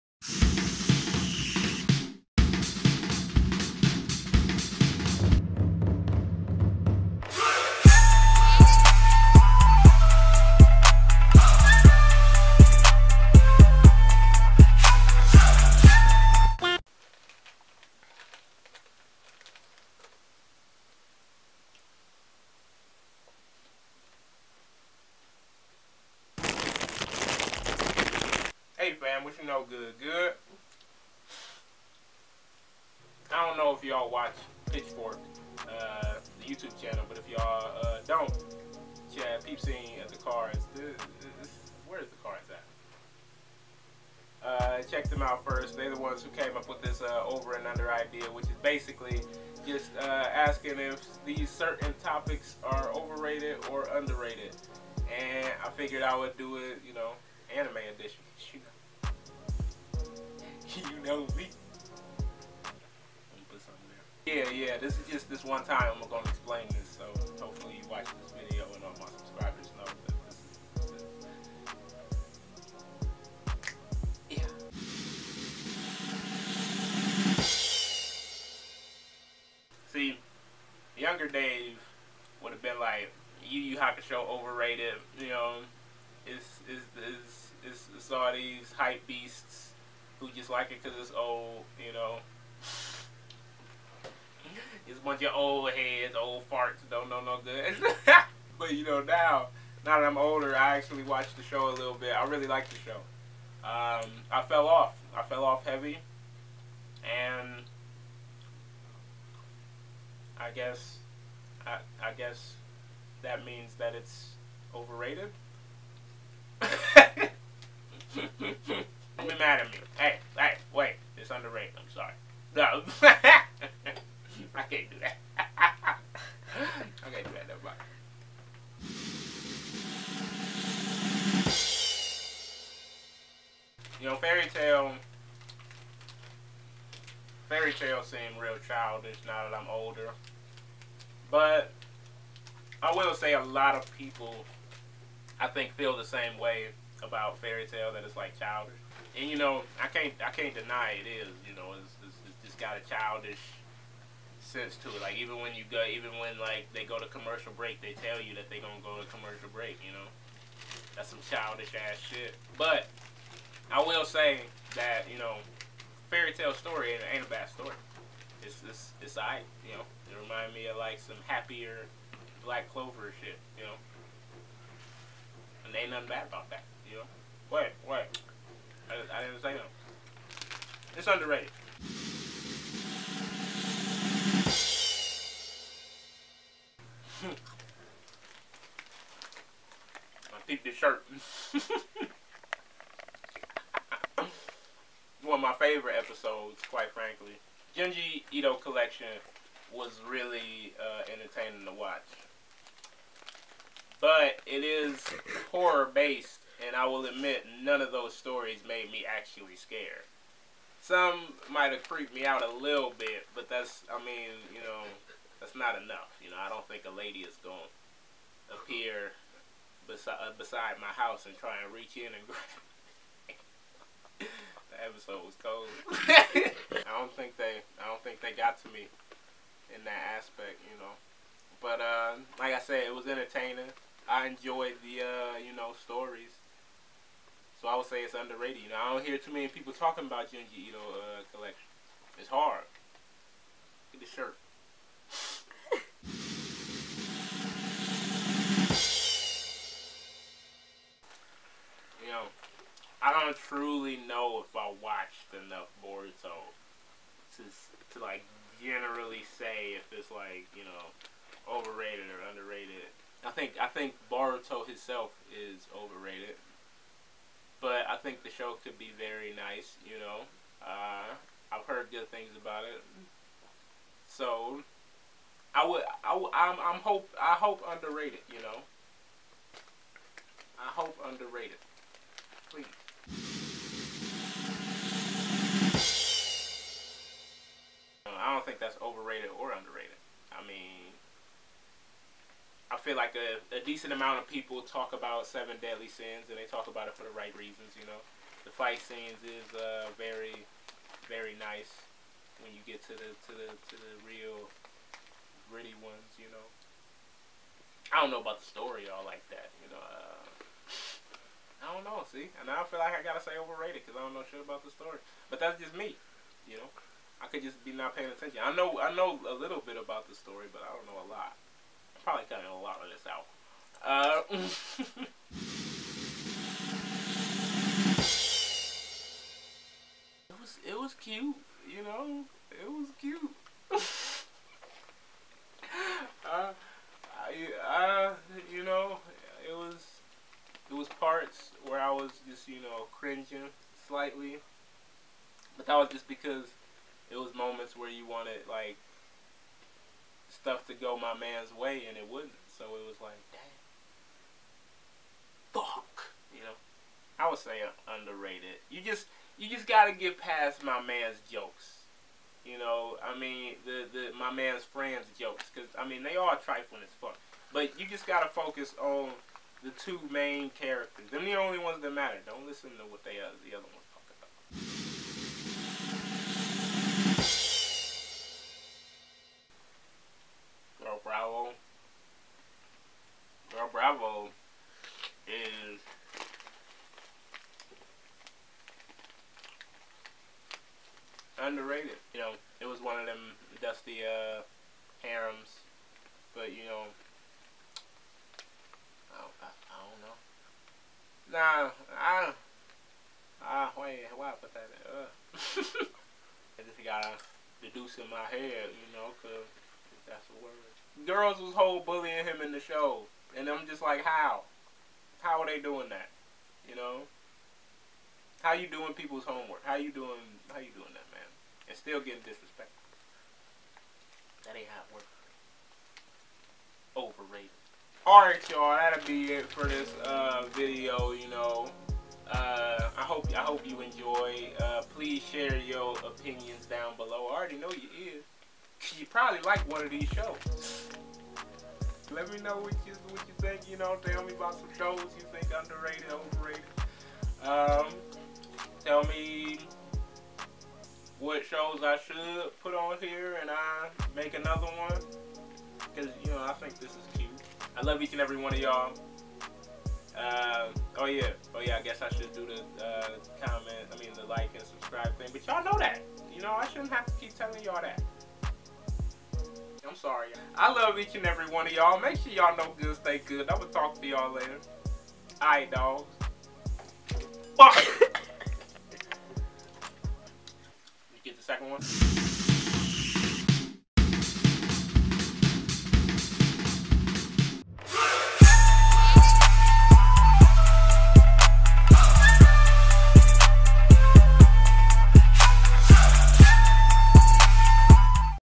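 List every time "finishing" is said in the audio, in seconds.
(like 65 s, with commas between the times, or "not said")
not said.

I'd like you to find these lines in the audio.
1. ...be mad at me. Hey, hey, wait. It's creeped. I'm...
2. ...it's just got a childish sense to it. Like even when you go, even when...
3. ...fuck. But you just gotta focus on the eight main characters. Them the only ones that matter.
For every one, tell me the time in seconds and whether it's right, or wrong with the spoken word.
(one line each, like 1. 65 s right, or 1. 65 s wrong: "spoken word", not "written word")
1. 119 s wrong: "underrated", not "creeped"
2. 152 s right
3. 366 s wrong: "two", not "eight".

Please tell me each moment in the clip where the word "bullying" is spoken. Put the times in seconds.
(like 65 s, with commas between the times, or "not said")
411 s.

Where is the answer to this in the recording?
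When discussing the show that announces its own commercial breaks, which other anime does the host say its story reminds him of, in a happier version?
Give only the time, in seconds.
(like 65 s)
172 s.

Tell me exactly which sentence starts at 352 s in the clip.
So it was like, damn, fuck, you know.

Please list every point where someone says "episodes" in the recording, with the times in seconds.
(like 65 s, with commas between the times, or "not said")
195 s, 224 s.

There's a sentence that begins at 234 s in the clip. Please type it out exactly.
I enjoyed the, uh, you know, stories.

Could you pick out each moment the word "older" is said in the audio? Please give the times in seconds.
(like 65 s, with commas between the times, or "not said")
100 s, 139 s.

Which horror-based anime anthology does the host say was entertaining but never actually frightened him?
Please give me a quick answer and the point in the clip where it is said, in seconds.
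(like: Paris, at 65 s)
Junji Ito Collection, at 197 s.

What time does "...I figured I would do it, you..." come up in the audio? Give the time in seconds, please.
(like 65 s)
55 s.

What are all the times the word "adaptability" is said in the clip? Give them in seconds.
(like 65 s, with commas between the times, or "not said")
not said.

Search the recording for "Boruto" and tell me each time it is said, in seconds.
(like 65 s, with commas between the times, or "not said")
255 s, 264 s.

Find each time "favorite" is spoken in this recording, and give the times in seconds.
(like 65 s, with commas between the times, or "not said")
195 s.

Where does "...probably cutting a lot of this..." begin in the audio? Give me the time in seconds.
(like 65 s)
322 s.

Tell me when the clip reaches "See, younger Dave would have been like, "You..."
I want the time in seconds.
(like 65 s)
79 s.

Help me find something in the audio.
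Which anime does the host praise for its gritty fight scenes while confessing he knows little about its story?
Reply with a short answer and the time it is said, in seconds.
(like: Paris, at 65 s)
Seven Deadly Sins, at 295 s.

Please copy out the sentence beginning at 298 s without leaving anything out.
The fight scenes is uh, very, very nice when you get to the to the to the real gritty ones, you know.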